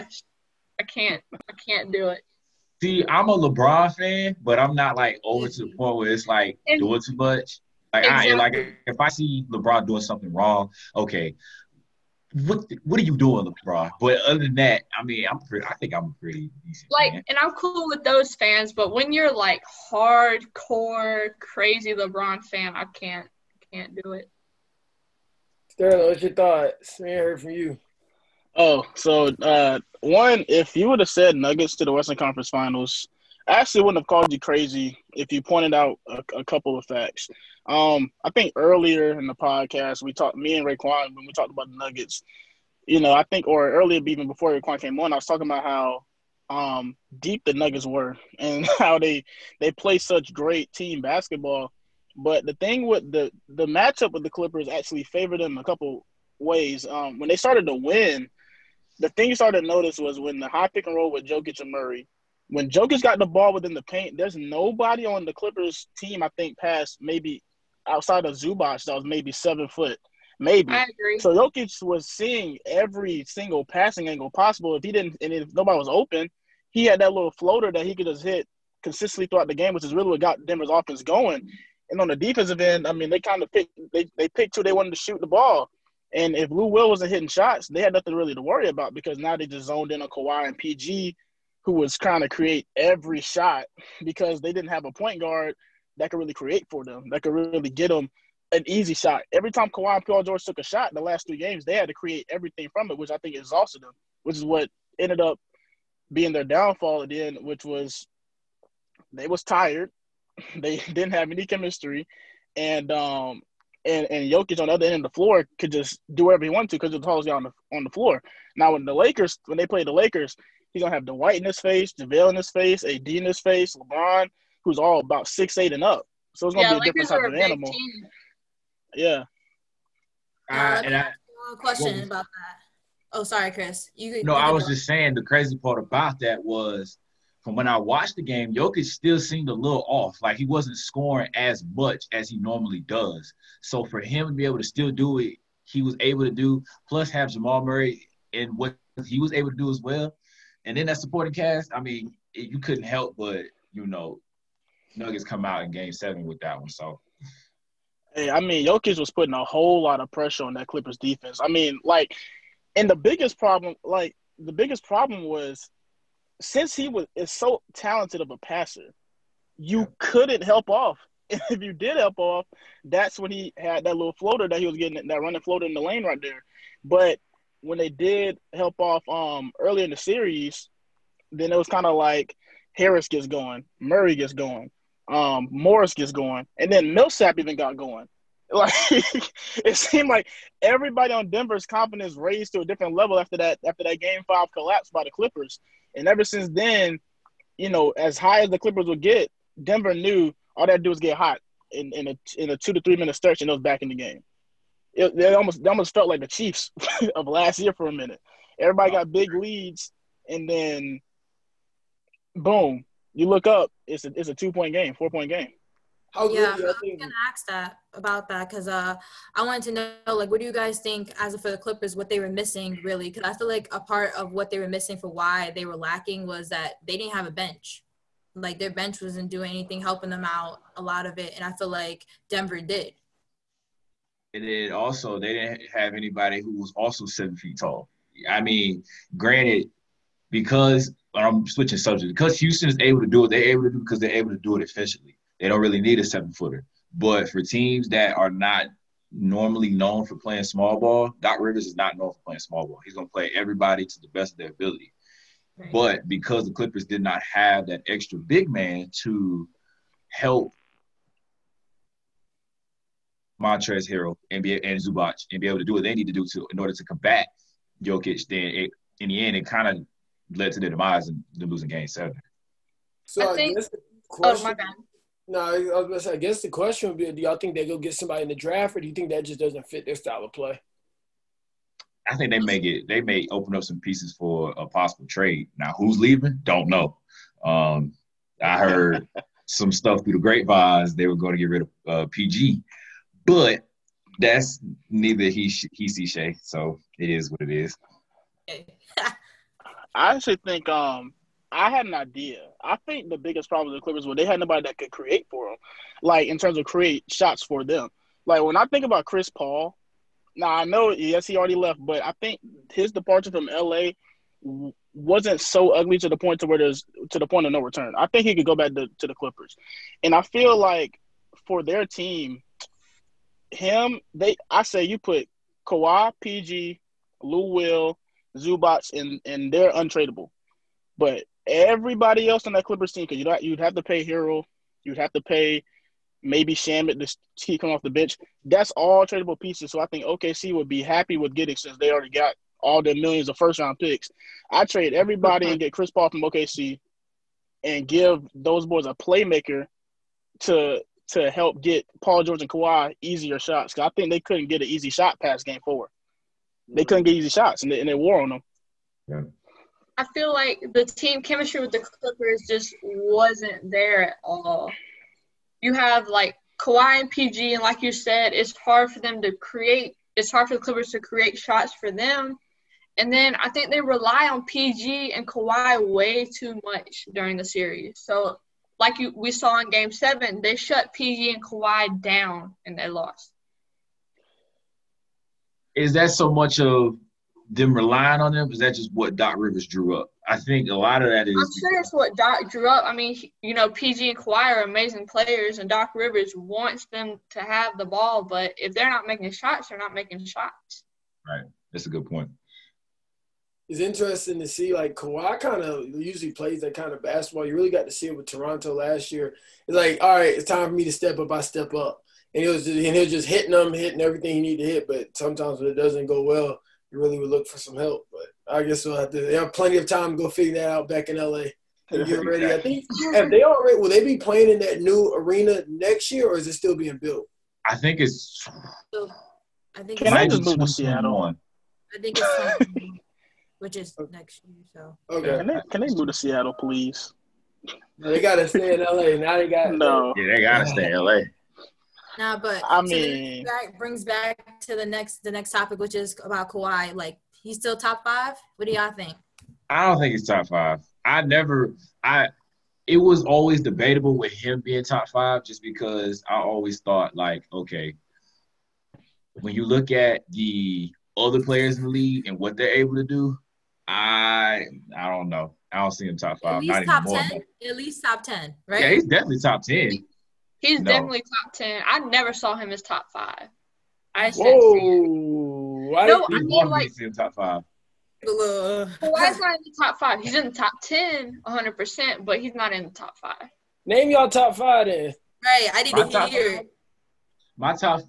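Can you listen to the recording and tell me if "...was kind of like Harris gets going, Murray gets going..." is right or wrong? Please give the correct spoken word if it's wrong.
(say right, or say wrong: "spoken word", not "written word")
right.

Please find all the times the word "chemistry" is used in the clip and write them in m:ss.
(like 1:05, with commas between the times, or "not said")
1:51, 6:01.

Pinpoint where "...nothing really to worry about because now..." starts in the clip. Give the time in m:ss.
1:27.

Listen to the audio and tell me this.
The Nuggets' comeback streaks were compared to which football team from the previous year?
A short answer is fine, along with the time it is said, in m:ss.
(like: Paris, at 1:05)
the Chiefs, at 3:26.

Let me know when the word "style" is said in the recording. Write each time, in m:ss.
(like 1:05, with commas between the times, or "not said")
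4:39.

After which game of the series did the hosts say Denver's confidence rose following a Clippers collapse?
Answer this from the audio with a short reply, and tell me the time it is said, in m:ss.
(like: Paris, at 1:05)
Game 5, at 3:14.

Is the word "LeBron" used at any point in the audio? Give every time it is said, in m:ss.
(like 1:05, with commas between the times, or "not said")
0:03, 0:09, 0:13, 0:21, 2:03.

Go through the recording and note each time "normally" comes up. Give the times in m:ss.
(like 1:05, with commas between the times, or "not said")
2:22, 4:09.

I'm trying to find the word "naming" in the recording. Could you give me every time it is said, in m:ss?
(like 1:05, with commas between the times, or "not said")
not said.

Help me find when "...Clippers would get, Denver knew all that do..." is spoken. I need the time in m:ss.
3:18.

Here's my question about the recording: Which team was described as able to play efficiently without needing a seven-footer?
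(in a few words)
Houston.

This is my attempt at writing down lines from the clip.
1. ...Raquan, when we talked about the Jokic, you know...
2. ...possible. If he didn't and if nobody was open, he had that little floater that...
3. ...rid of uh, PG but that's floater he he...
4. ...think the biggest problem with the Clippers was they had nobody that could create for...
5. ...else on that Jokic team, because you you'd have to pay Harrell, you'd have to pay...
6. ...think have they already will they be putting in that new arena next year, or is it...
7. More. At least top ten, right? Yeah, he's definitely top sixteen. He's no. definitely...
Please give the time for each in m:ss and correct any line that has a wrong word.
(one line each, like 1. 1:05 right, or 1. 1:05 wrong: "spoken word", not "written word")
1. 0:40 wrong: "Nuggets", not "Jokic"
2. 1:14 right
3. 4:51 wrong: "neither", not "floater"
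4. 5:02 right
5. 5:32 wrong: "Clippers", not "Jokic"
6. 7:02 wrong: "playing", not "putting"
7. 7:47 wrong: "ten", not "sixteen".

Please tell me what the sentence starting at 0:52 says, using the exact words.
But the thing with the the matchup with the Clippers actually favored them a couple ways.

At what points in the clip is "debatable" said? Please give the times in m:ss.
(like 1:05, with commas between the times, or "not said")
7:33.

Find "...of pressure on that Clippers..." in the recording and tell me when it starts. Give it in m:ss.
2:40.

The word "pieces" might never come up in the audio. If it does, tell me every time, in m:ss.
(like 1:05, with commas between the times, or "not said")
4:43, 5:39.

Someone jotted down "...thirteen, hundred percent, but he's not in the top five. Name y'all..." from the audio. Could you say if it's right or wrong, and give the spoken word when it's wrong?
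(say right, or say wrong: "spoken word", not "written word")
wrong: "ten", not "thirteen".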